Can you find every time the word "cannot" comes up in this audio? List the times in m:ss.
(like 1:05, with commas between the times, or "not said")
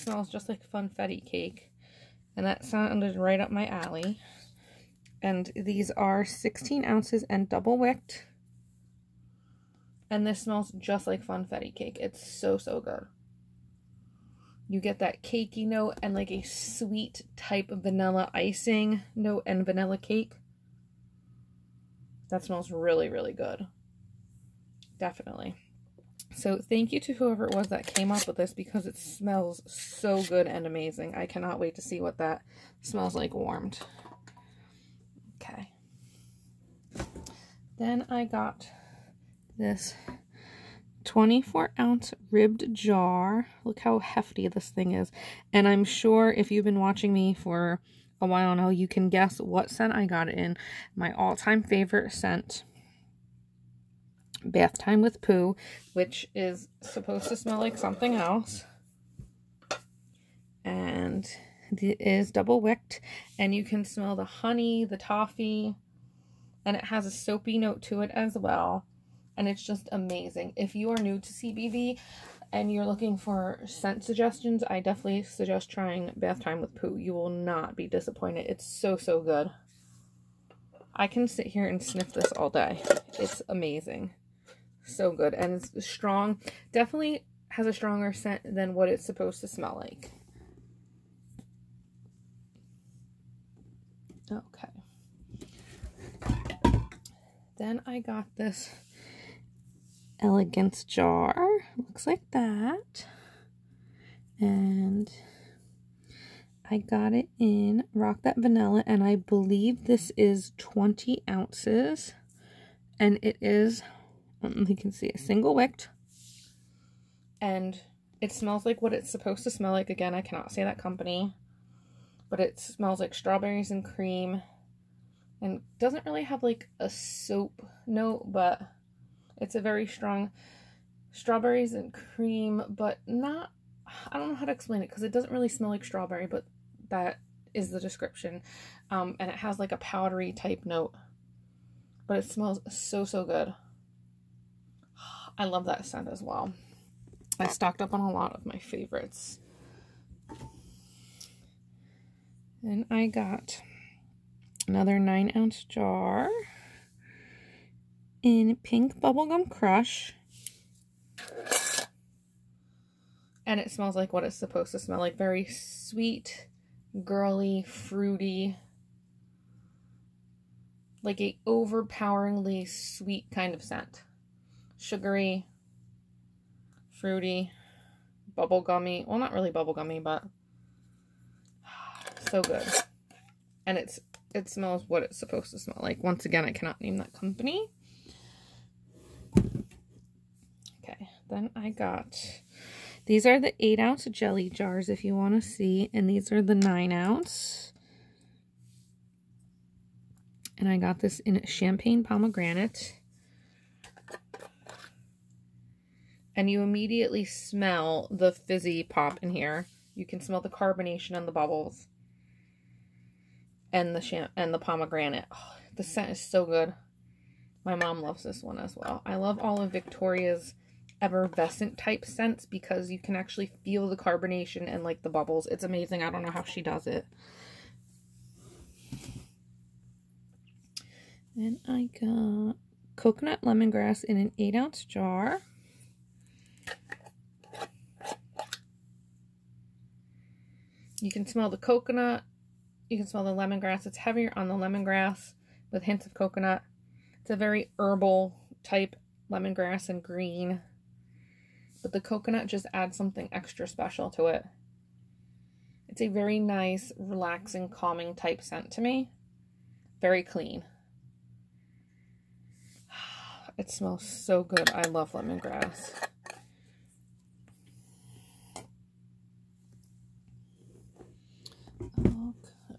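0:31, 2:00, 3:06.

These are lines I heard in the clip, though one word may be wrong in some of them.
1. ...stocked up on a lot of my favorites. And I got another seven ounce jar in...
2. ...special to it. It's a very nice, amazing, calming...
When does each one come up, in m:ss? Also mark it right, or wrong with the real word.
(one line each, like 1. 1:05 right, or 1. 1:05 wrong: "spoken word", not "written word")
1. 2:27 wrong: "nine", not "seven"
2. 4:13 wrong: "relaxing", not "amazing".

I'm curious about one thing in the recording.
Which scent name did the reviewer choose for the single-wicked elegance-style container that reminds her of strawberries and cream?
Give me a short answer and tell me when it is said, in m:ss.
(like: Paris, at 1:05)
Rock That Vanilla, at 1:47.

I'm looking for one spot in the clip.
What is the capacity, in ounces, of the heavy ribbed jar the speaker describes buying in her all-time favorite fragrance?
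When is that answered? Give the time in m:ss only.
0:41.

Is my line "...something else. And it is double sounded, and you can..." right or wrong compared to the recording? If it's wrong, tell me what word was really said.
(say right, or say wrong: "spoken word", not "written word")
wrong: "wicked", not "sounded".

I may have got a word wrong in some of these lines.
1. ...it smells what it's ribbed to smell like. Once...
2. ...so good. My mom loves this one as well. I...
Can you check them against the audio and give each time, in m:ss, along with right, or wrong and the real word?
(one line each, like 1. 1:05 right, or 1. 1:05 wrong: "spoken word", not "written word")
1. 3:04 wrong: "supposed", not "ribbed"
2. 3:36 right.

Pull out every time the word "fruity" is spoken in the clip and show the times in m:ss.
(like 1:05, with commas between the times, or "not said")
2:47, 2:56.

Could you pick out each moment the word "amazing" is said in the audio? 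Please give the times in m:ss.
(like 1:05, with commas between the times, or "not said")
0:30, 1:09, 1:23, 3:45.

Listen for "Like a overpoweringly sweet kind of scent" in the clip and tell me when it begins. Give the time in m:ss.
2:51.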